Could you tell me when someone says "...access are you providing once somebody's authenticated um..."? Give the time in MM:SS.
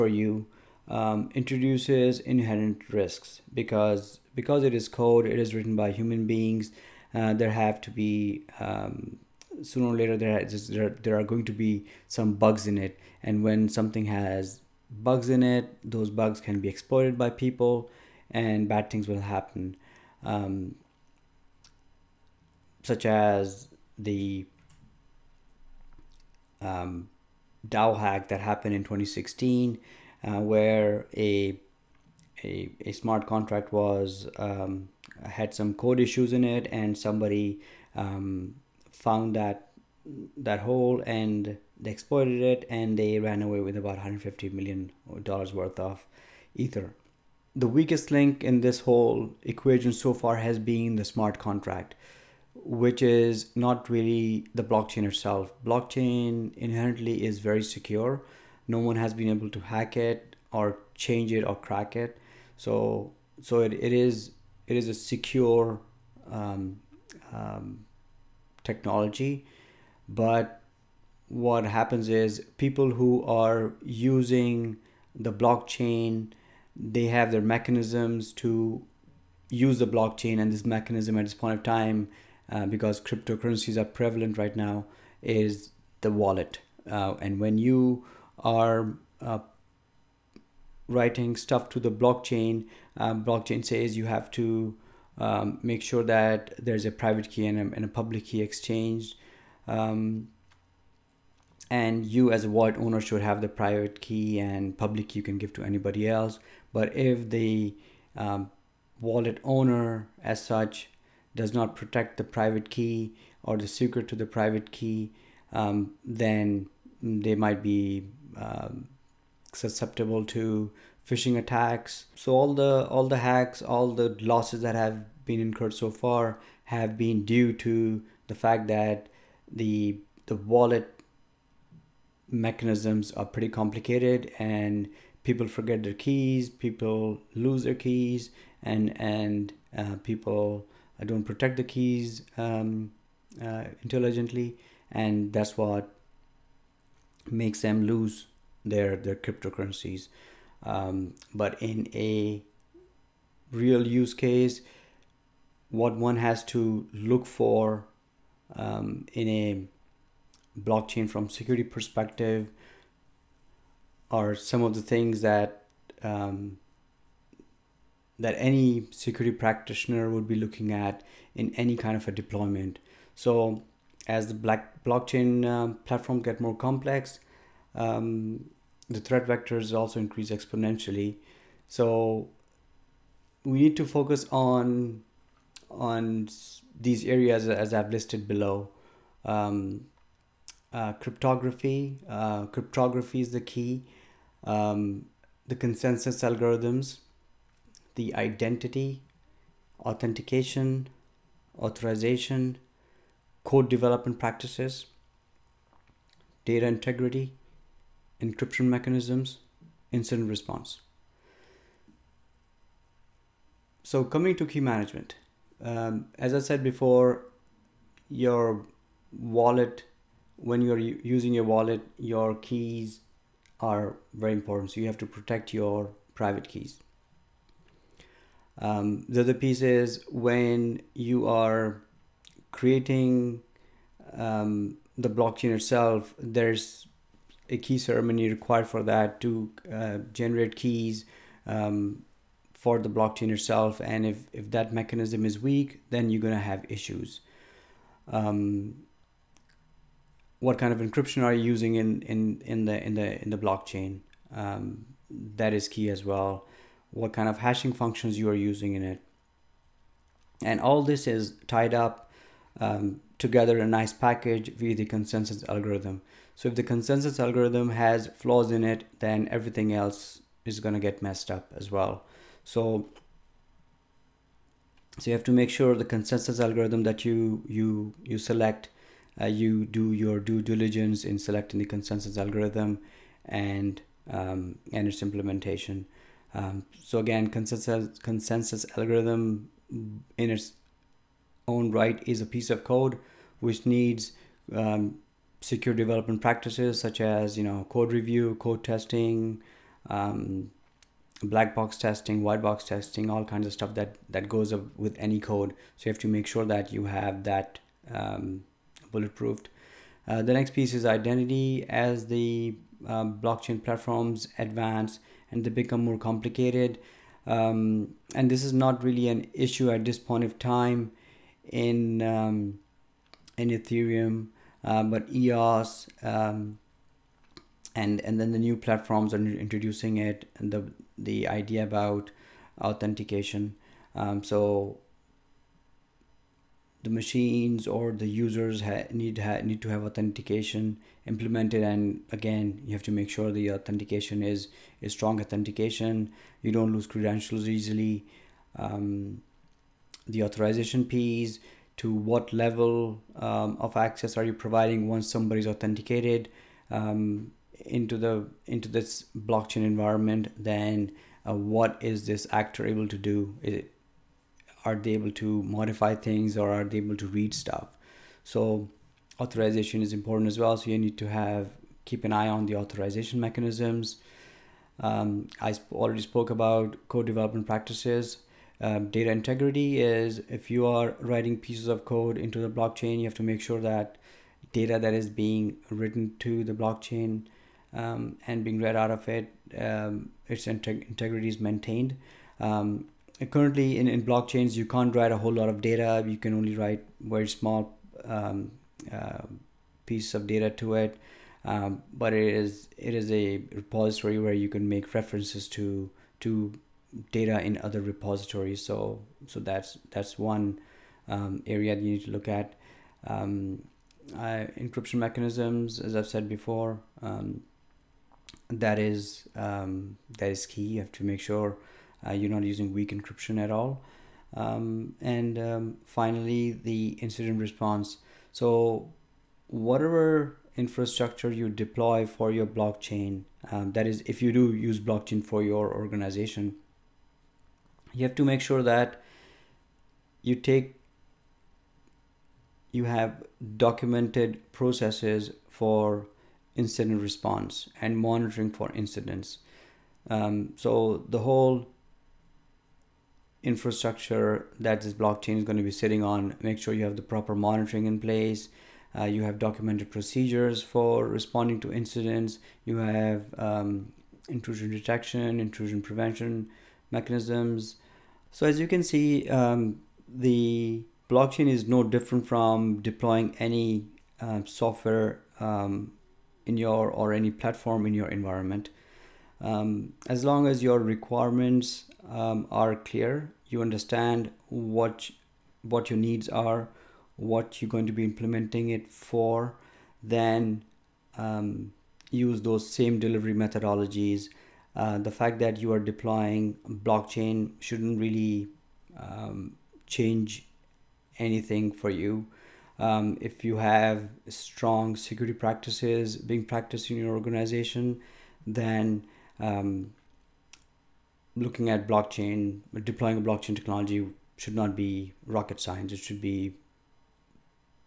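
05:53.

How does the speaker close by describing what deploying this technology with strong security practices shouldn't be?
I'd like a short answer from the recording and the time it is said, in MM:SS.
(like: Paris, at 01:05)
Rocket science, at 08:35.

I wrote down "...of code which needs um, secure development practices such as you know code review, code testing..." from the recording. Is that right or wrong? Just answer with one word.
right.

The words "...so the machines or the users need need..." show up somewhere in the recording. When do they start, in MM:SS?
05:34.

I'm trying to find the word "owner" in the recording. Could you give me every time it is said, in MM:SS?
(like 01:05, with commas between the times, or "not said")
01:42, 01:49.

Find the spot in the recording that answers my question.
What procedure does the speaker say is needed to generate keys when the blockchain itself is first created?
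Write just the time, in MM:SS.
03:57.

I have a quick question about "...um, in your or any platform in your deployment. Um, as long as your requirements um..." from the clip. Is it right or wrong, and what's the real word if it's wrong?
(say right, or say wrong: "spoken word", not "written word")
wrong: "environment", not "deployment".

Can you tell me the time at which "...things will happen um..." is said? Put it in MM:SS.
00:18.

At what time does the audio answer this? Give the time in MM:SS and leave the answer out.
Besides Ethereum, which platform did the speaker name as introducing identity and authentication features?
05:25.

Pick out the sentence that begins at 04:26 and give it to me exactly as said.
So if the consensus algorithm has flaws in it, then everything else is going to get messed up as well.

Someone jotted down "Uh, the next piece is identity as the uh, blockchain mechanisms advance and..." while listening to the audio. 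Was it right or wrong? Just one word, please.
wrong.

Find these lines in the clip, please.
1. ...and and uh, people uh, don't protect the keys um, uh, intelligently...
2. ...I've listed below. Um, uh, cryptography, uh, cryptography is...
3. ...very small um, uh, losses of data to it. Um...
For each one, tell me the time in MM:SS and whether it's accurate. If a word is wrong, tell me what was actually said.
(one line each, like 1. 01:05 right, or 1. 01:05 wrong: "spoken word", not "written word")
1. 02:18 right
2. 03:07 right
3. 06:36 wrong: "pieces", not "losses".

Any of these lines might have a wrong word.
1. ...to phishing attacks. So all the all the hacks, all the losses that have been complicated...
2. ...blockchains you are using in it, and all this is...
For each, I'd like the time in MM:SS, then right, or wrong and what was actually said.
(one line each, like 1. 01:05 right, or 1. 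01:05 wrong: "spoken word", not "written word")
1. 02:00 wrong: "incurred", not "complicated"
2. 04:17 wrong: "functions", not "blockchains".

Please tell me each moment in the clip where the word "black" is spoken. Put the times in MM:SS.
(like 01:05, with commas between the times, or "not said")
02:54, 05:01.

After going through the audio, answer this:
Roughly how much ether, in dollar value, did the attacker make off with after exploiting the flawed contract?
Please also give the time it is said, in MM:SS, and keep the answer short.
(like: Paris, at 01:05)
150 million dollars, at 00:43.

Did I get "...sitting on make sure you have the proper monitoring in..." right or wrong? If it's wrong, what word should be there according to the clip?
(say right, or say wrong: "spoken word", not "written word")
right.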